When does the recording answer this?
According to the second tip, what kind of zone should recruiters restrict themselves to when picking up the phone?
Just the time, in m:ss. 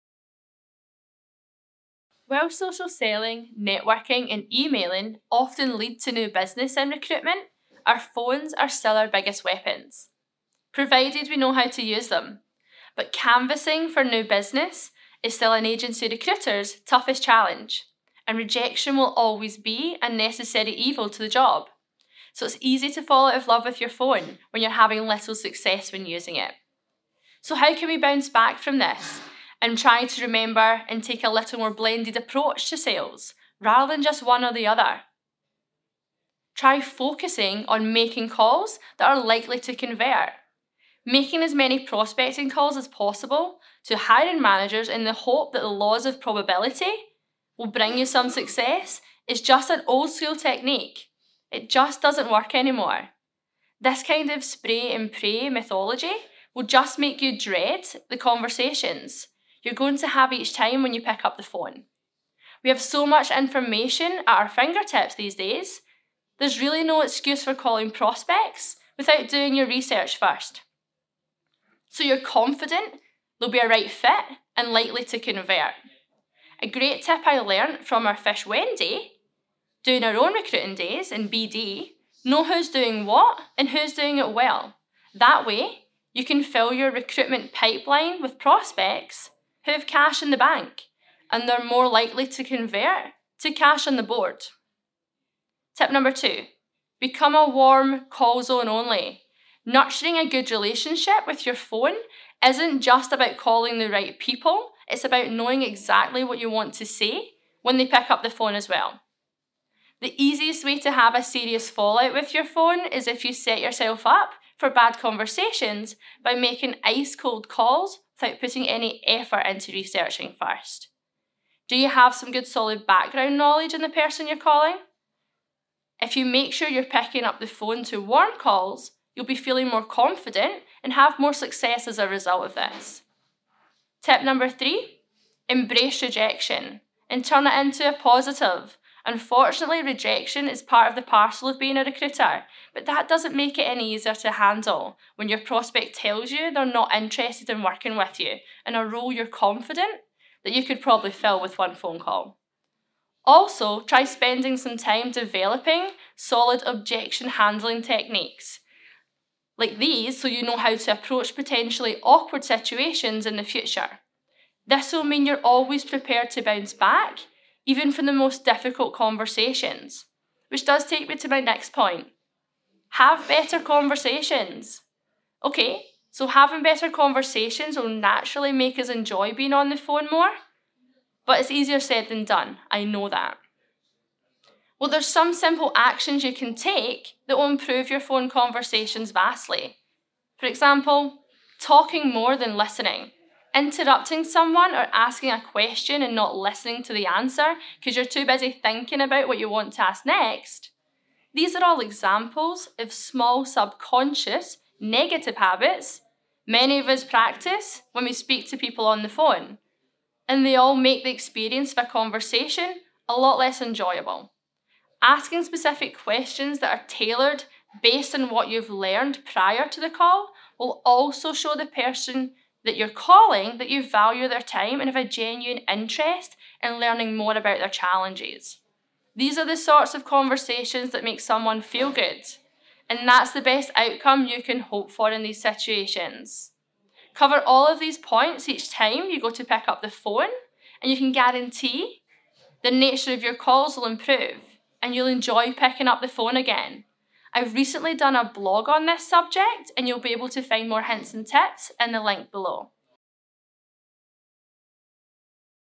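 1:37.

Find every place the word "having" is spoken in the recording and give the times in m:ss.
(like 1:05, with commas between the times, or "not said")
0:24, 2:56.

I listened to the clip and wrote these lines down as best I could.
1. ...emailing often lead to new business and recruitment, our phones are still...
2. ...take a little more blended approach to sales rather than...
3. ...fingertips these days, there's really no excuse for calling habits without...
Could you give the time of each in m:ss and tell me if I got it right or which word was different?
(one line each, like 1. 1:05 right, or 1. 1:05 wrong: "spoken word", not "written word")
1. 0:04 right
2. 0:31 right
3. 1:04 wrong: "prospects", not "habits".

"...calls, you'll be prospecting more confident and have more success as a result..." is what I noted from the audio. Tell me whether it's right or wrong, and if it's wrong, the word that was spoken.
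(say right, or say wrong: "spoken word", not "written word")
wrong: "feeling", not "prospecting".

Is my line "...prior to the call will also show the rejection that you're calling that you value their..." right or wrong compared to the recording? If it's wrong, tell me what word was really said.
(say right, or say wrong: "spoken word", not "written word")
wrong: "person", not "rejection".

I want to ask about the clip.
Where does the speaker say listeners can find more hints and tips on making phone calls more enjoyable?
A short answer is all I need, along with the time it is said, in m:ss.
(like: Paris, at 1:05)
a blog, at 4:08.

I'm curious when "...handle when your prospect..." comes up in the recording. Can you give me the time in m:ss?
2:24.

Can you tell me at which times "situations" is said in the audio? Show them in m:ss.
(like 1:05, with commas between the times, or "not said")
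2:42, 3:55.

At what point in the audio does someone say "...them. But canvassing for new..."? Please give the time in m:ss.
0:12.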